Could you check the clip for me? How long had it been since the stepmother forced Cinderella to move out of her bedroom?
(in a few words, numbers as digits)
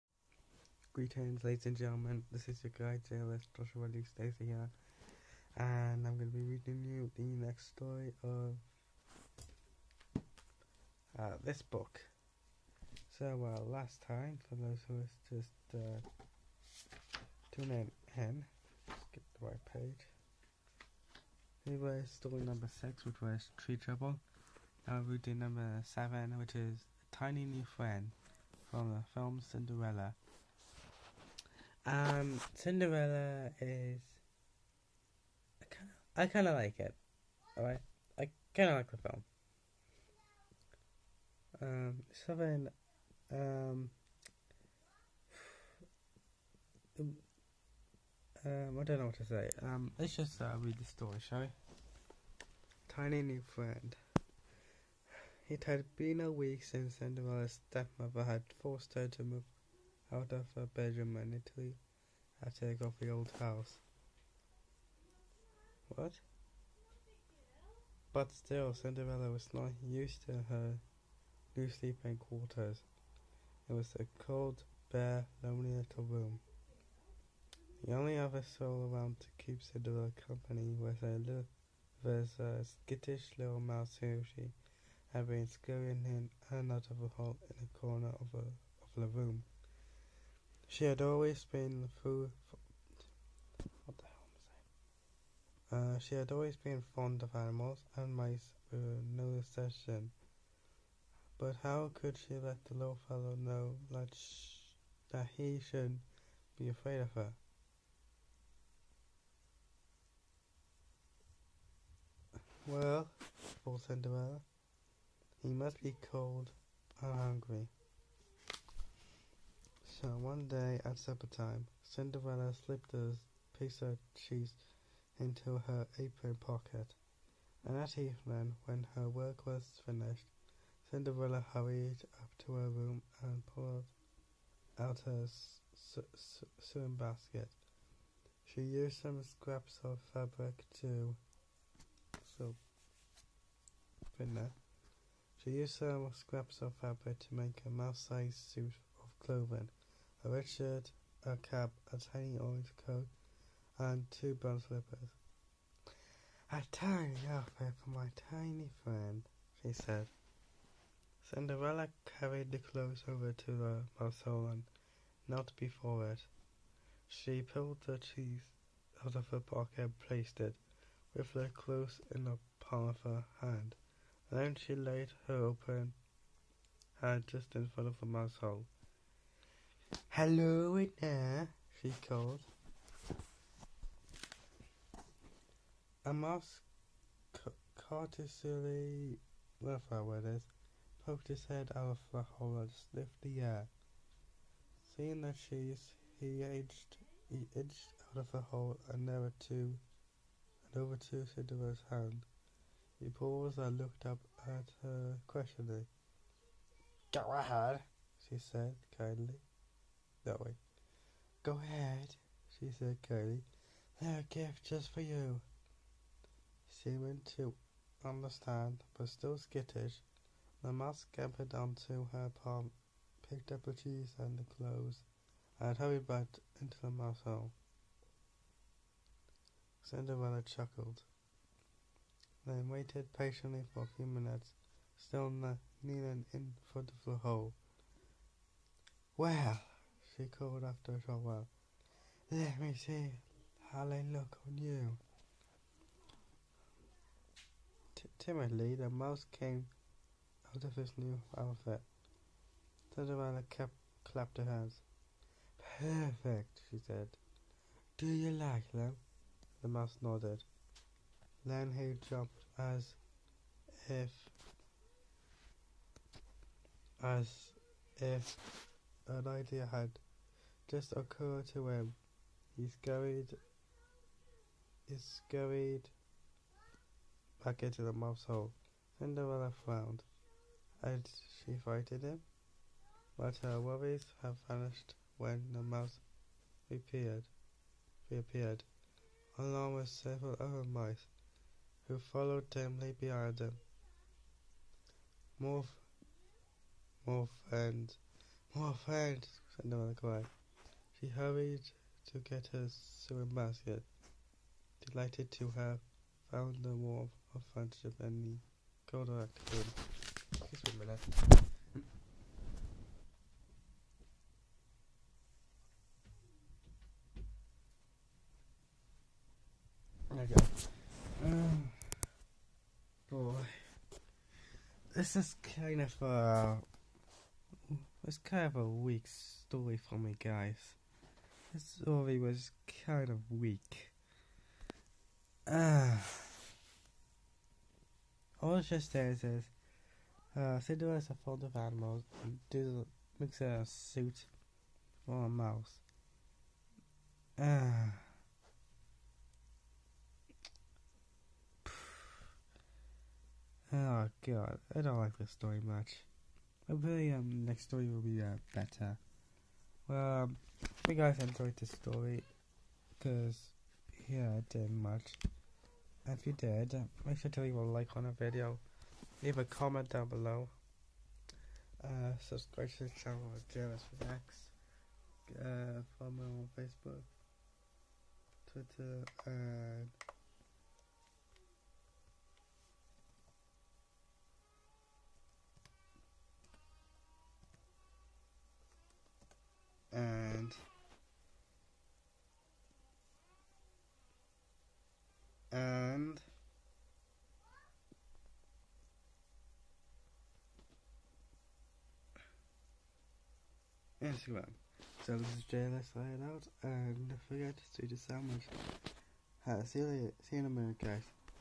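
a week.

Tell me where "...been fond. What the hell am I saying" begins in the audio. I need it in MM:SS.
01:31.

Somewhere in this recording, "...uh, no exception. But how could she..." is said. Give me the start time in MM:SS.
01:38.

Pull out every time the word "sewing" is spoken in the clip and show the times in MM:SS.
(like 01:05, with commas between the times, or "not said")
02:16, 05:02.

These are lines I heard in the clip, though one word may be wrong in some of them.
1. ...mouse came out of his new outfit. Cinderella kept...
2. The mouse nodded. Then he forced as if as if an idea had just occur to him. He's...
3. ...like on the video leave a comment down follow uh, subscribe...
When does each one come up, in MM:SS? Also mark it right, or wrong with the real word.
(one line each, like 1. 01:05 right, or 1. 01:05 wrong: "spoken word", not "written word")
1. 04:08 right
2. 04:19 wrong: "jumped", not "forced"
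3. 06:07 wrong: "below", not "follow".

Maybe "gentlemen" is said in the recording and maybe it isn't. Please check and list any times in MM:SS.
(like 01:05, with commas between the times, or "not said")
00:01.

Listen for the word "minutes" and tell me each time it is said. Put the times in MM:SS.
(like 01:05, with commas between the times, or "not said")
03:54, 06:50.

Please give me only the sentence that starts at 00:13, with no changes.
So, uh, last time, for those who is just uh, tuning in, skip the right page.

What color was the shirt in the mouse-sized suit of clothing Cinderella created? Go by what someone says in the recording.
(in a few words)
red.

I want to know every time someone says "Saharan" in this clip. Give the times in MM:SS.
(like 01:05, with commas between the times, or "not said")
not said.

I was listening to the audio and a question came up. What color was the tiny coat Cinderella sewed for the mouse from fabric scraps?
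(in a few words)
orange.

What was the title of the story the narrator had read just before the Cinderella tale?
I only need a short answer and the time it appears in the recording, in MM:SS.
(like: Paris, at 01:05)
Tree Trouble, at 00:23.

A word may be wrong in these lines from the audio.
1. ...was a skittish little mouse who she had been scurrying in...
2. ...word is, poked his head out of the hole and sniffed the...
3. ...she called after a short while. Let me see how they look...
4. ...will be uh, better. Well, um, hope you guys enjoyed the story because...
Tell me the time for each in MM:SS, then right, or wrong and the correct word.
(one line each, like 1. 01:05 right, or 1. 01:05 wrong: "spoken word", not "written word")
1. 01:22 right
2. 03:10 right
3. 04:00 right
4. 05:57 right.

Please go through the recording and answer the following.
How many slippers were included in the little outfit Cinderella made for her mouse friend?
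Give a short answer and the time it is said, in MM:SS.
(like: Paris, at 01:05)
2, at 02:34.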